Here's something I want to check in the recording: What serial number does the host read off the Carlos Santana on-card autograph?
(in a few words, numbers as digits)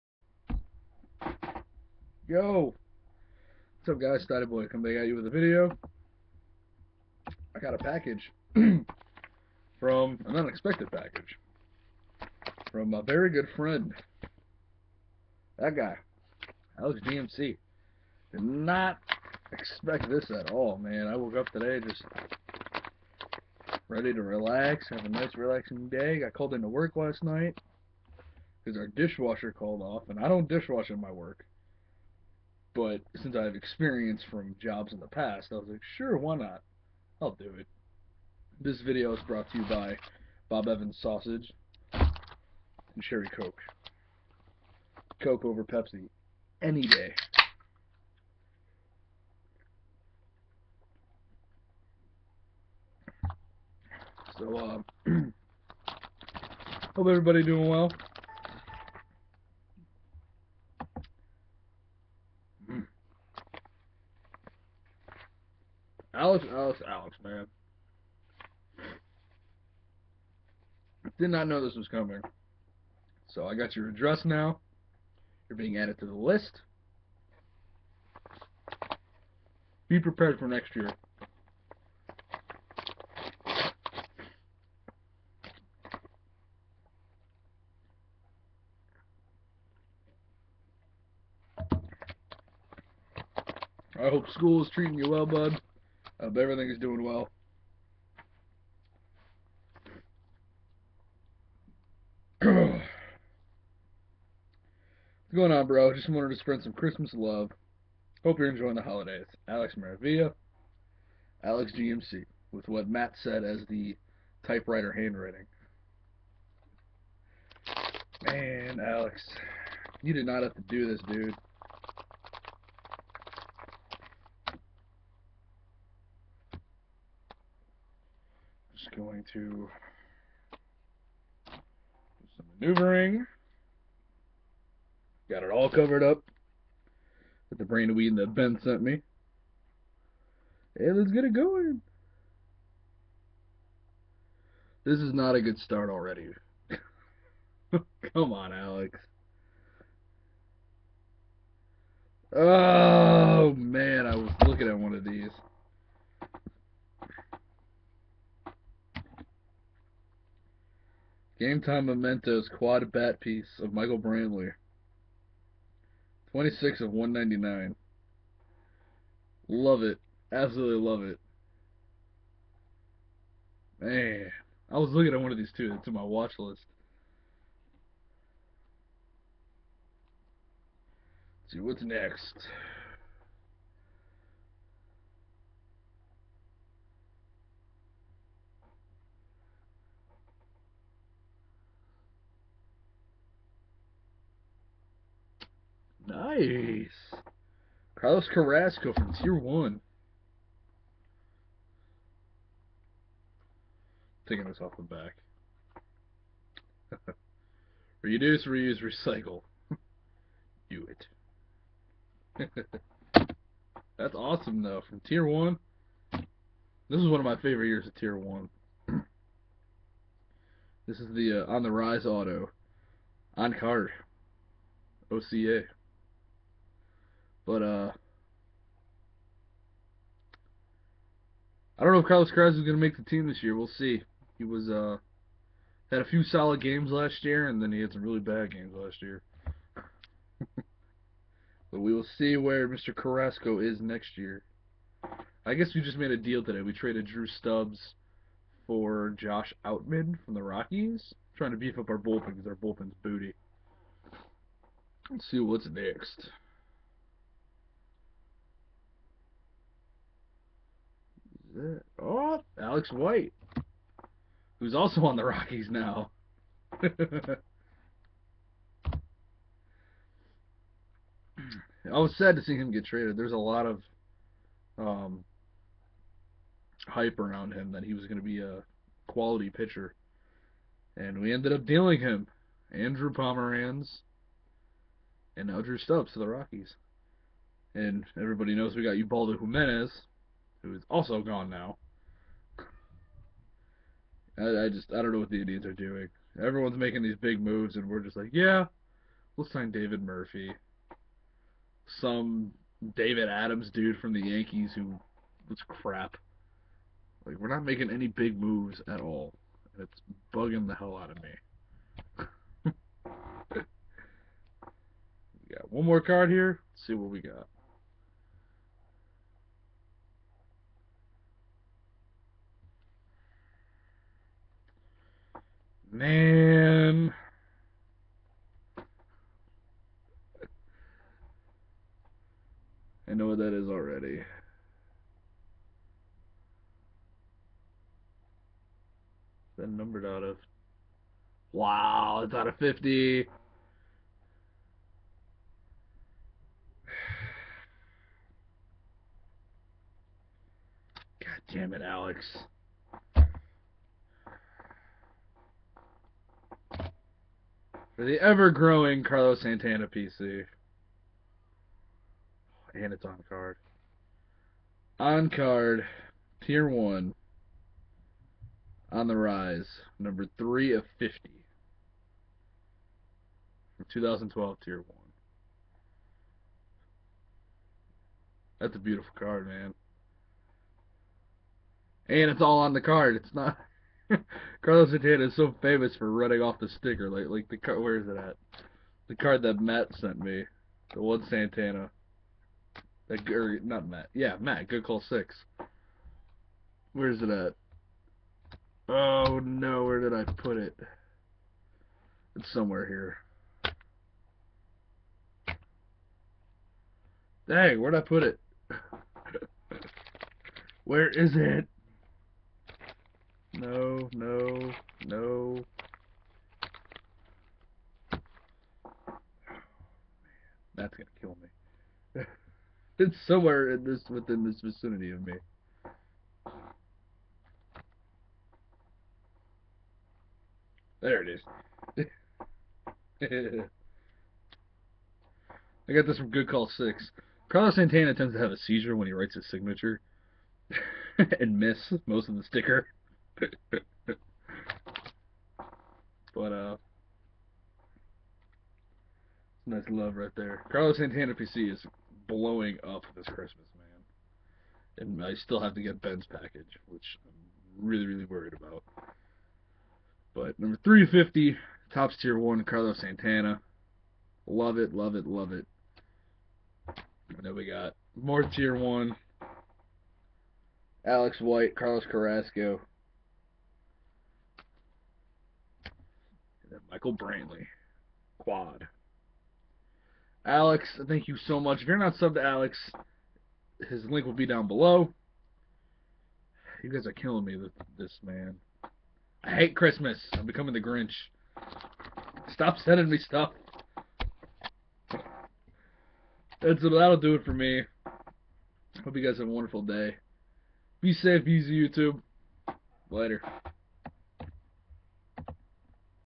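3 of 50.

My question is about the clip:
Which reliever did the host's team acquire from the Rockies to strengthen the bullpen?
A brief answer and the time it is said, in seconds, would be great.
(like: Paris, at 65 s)
Josh Outman, at 249 s.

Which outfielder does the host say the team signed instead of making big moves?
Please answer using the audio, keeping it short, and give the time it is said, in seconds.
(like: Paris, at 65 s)
David Murphy, at 299 s.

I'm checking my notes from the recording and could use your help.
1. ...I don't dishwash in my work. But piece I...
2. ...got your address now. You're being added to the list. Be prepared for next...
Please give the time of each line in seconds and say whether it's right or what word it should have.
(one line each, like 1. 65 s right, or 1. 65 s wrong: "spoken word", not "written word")
1. 30 s wrong: "since", not "piece"
2. 73 s right.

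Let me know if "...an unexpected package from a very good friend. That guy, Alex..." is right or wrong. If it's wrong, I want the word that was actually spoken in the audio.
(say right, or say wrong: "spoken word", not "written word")
right.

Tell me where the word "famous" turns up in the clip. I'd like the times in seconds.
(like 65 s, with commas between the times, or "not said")
385 s.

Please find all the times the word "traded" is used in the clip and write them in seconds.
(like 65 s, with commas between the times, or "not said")
246 s, 272 s.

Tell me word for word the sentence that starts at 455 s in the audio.
And I still have to get Ben's package, which I'm really, really worried about.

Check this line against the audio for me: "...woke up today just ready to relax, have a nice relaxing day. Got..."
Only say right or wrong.
right.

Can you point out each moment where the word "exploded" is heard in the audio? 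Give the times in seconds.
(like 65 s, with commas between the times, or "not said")
not said.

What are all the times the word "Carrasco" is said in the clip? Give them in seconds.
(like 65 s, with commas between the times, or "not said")
198 s, 232 s, 242 s, 472 s.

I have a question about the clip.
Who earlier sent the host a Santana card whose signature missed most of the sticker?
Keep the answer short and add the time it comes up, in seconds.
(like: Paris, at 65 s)
Good Call 6, at 436 s.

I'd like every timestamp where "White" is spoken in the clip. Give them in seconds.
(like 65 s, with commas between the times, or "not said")
262 s, 471 s.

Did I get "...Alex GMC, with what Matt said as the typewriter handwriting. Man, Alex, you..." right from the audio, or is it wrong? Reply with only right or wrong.
right.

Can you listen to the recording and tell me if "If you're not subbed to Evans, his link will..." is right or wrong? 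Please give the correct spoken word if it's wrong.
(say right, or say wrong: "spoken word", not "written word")
wrong: "Alex", not "Evans".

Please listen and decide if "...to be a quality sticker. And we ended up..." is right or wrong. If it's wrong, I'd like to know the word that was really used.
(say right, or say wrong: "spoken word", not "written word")
wrong: "pitcher", not "sticker".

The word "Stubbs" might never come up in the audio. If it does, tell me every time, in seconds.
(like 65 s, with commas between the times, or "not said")
247 s, 285 s.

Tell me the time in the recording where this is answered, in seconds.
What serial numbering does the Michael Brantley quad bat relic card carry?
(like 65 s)
166 s.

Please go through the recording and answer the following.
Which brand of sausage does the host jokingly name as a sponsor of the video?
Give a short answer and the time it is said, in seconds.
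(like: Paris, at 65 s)
Bob Evans, at 40 s.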